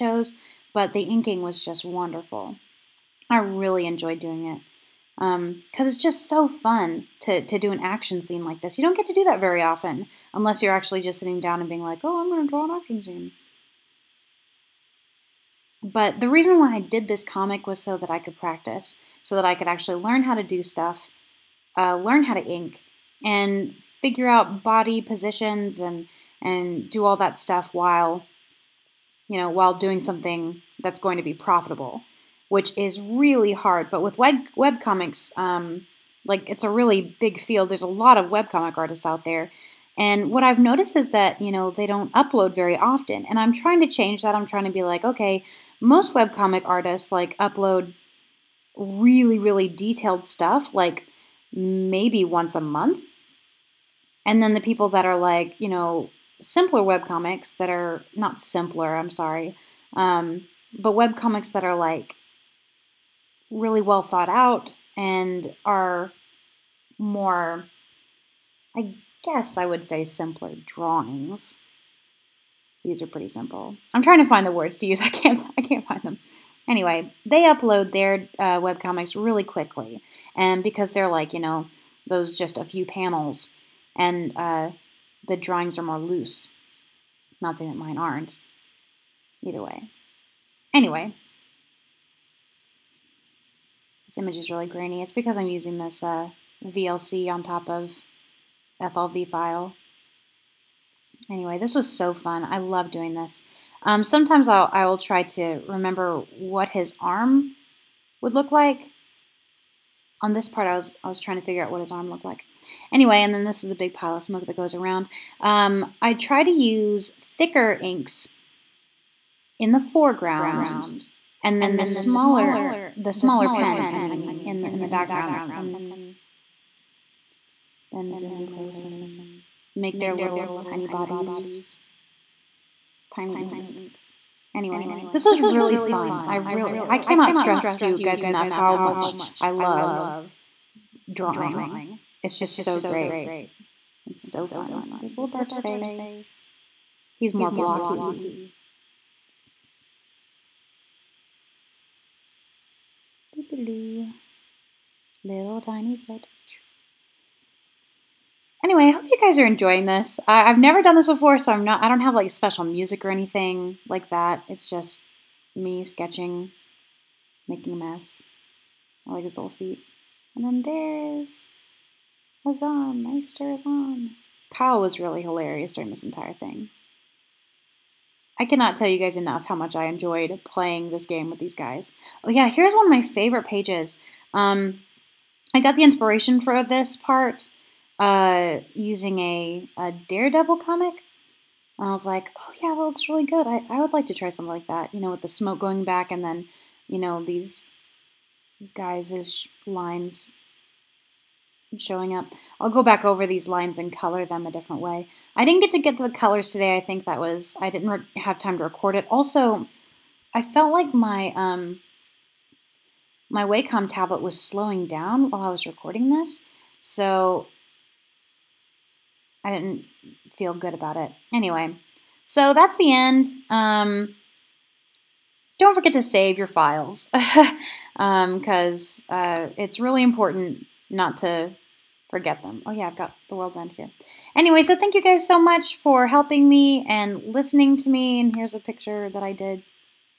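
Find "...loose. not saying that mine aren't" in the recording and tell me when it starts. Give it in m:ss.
1:25.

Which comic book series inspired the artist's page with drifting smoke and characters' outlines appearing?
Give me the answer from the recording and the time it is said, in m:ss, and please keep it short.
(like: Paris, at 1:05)
Daredevil, at 3:10.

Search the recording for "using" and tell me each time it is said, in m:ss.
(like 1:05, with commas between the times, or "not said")
1:35, 3:08.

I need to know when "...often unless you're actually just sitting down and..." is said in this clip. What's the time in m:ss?
0:09.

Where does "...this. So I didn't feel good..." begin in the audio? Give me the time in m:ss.
3:36.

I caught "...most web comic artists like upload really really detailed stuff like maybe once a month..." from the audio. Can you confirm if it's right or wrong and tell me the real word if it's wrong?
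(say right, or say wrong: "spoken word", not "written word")
right.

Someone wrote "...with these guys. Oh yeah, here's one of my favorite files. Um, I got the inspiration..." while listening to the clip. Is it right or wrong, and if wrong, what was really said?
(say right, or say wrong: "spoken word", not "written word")
wrong: "pages", not "files".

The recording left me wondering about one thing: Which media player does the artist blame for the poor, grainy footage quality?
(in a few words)
VLC.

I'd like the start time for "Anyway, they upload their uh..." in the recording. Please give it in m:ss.
1:16.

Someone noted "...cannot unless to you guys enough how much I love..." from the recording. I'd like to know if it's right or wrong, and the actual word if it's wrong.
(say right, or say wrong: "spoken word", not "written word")
wrong: "stress", not "unless".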